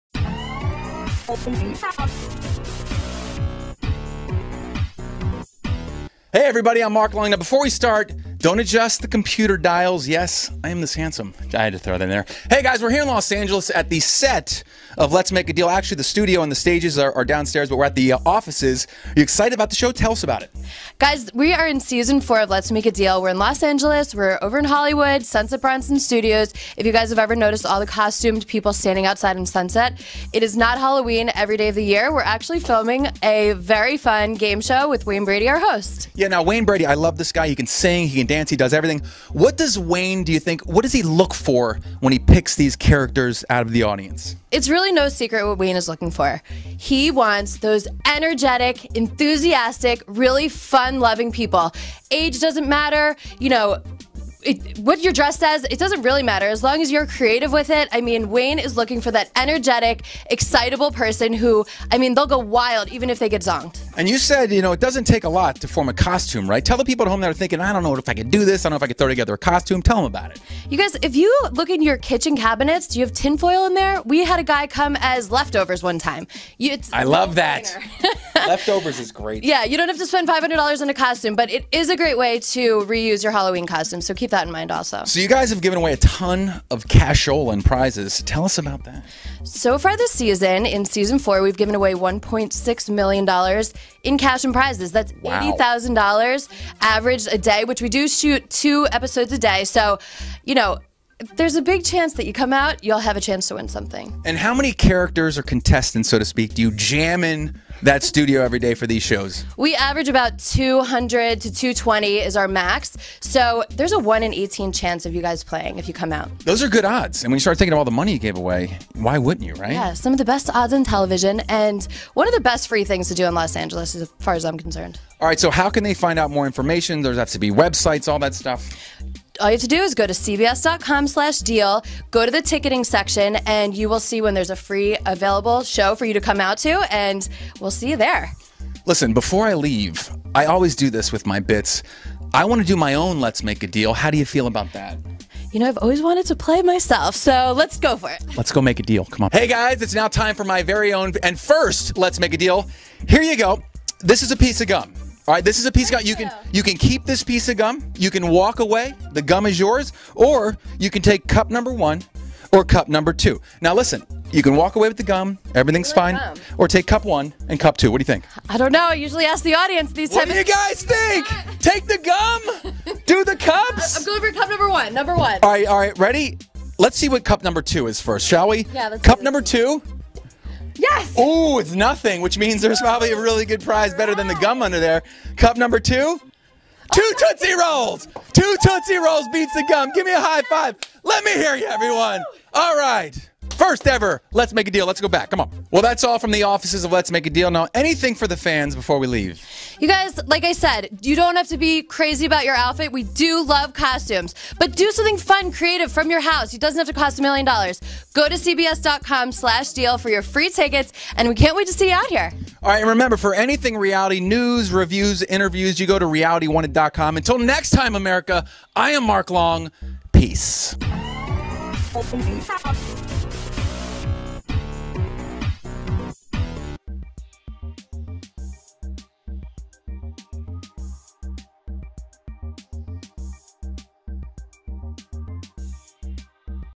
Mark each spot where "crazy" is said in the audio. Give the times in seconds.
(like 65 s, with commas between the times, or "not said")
201 s.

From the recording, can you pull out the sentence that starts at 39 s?
What does Wayne, do you think, what does he look for when he picks these characters out of the audience?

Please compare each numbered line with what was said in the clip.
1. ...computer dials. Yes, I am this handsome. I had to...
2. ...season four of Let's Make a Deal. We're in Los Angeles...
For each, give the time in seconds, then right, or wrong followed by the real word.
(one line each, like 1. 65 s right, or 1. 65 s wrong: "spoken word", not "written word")
1. 9 s right
2. 21 s right.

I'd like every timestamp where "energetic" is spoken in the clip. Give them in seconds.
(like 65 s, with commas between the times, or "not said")
48 s, 59 s.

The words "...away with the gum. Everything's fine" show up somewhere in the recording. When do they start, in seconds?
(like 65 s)
164 s.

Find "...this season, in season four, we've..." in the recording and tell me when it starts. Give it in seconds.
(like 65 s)
89 s.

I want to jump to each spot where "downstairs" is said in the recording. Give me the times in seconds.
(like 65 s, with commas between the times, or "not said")
17 s.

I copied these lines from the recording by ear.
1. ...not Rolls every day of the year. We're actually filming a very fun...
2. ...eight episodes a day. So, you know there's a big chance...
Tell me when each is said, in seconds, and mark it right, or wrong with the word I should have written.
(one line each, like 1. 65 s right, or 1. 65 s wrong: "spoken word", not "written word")
1. 30 s wrong: "Halloween", not "Rolls"
2. 98 s wrong: "two", not "eight".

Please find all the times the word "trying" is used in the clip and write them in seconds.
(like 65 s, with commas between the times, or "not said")
not said.